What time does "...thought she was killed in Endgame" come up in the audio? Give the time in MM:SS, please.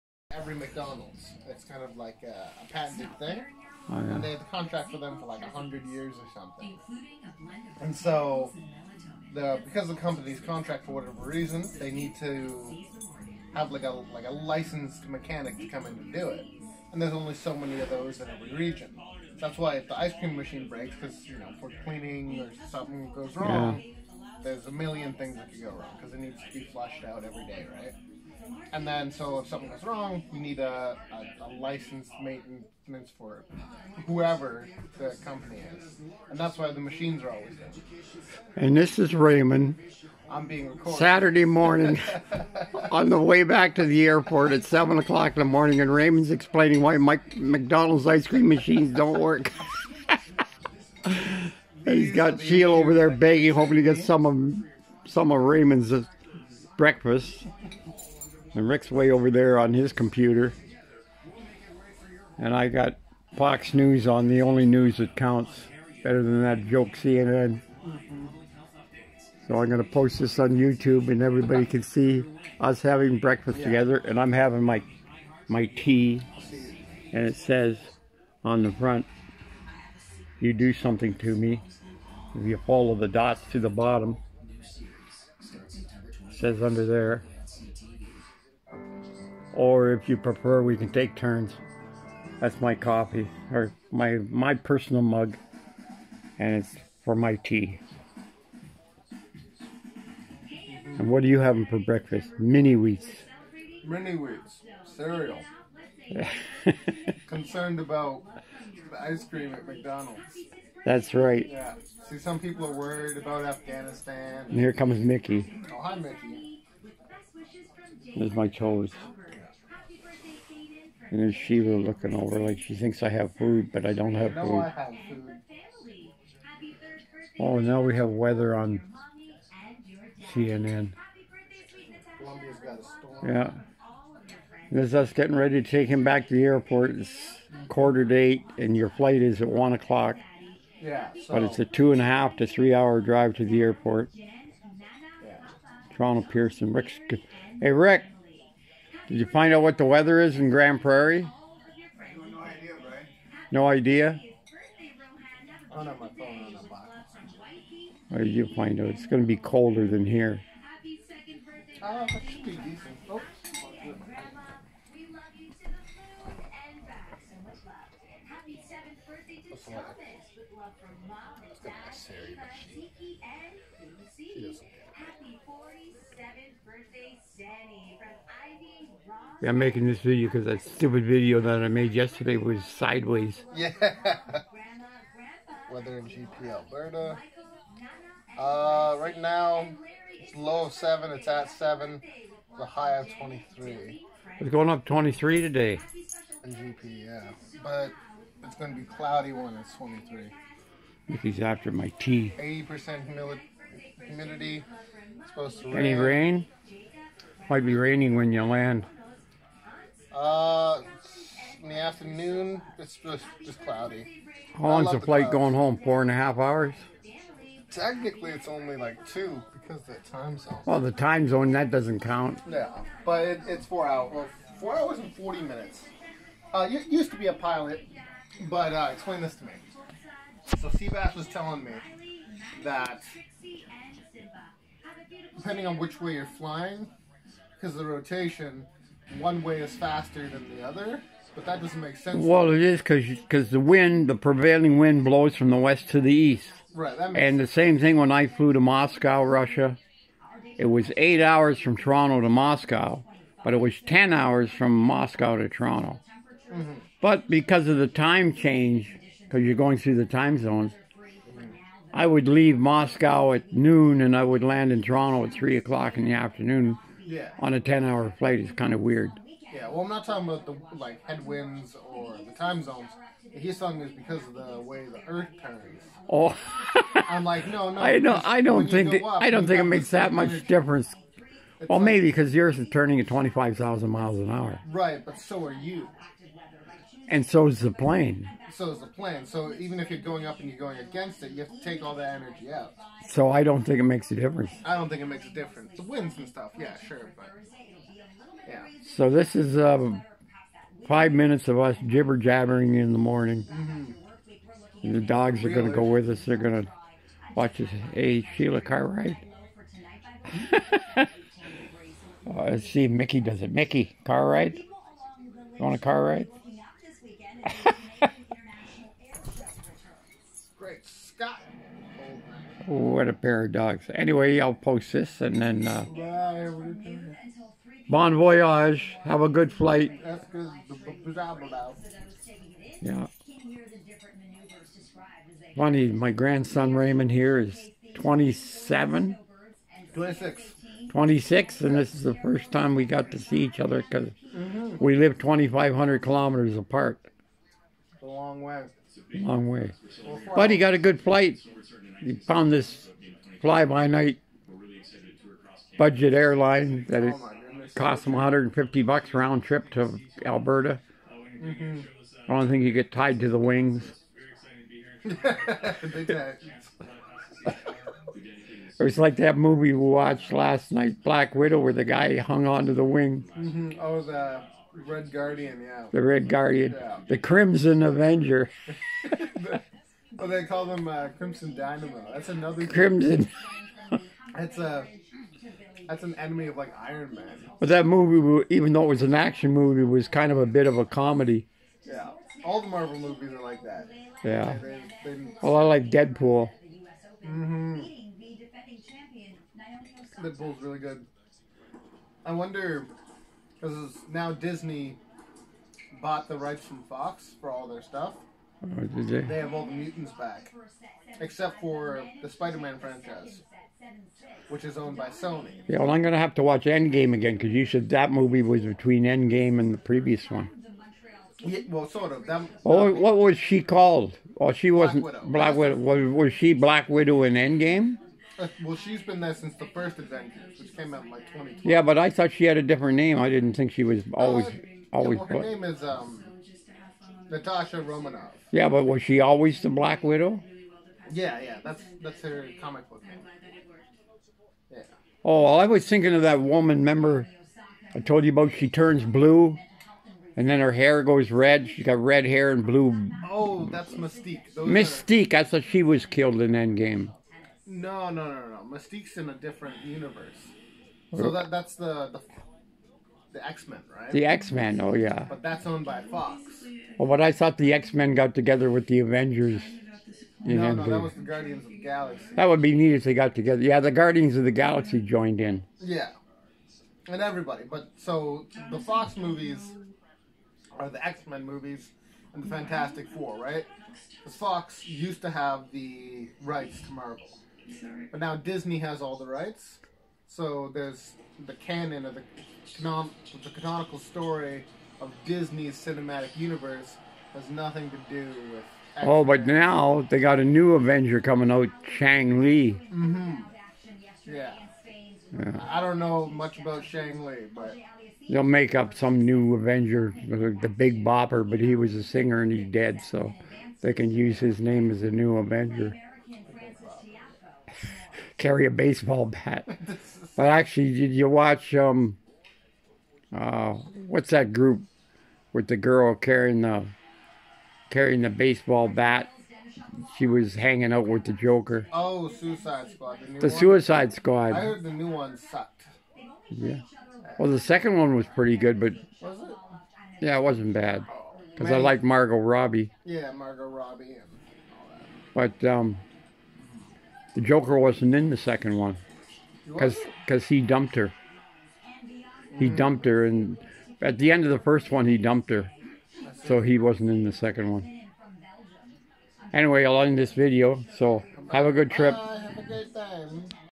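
07:35.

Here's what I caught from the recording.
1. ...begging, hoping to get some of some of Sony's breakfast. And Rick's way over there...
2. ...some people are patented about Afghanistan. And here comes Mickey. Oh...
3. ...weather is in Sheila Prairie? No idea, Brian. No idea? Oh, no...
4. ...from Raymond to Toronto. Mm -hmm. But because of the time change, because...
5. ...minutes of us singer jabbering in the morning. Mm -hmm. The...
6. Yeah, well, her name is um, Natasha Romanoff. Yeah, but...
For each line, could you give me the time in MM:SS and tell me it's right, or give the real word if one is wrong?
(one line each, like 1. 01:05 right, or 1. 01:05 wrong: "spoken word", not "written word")
1. 00:53 wrong: "Raymond", not "Sony"
2. 01:52 wrong: "worried", not "patented"
3. 02:29 wrong: "Grande", not "Sheila"
4. 04:14 wrong: "Moscow", not "Raymond"
5. 05:01 wrong: "jibber", not "singer"
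6. 07:15 right.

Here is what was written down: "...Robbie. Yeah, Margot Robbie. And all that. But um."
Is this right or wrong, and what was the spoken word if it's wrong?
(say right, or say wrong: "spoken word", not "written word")
right.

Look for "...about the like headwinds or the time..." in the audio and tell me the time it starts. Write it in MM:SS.
04:30.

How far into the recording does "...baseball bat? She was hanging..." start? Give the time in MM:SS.
08:48.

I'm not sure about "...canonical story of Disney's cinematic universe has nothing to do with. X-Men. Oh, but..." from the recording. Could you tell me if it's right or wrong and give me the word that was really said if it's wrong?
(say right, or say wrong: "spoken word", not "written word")
right.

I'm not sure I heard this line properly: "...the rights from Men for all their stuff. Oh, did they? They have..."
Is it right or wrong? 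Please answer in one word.
wrong.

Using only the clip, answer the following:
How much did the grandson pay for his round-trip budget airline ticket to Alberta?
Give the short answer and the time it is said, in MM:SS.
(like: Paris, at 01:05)
150 dollars, at 05:58.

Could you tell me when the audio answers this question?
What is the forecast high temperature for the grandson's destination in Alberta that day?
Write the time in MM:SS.
03:12.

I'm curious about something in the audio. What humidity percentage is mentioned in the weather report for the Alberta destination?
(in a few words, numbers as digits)
80%.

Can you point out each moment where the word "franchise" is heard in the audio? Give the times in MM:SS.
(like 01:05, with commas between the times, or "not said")
06:52.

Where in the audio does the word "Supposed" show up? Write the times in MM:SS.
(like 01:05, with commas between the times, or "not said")
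03:25.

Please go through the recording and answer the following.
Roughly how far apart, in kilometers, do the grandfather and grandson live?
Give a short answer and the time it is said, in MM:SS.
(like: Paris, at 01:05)
2,500 kilometers, at 05:45.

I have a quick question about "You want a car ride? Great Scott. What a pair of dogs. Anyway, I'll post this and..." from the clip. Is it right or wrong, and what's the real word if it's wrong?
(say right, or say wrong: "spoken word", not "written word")
right.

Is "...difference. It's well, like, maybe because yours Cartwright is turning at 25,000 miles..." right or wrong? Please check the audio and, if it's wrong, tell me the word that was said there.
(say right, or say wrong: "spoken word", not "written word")
wrong: "Earth", not "Cartwright".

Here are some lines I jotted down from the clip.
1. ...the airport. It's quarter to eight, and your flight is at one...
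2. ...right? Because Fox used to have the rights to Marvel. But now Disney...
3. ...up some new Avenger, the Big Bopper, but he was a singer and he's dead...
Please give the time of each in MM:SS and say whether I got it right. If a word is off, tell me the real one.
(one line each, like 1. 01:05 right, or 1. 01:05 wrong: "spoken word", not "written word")
1. 02:16 right
2. 08:03 right
3. 08:28 right.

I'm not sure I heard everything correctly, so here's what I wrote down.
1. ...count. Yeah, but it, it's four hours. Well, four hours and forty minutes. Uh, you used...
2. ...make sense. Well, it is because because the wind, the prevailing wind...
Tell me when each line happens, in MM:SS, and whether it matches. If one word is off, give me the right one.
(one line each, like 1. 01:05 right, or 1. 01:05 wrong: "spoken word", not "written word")
1. 03:42 right
2. 04:01 right.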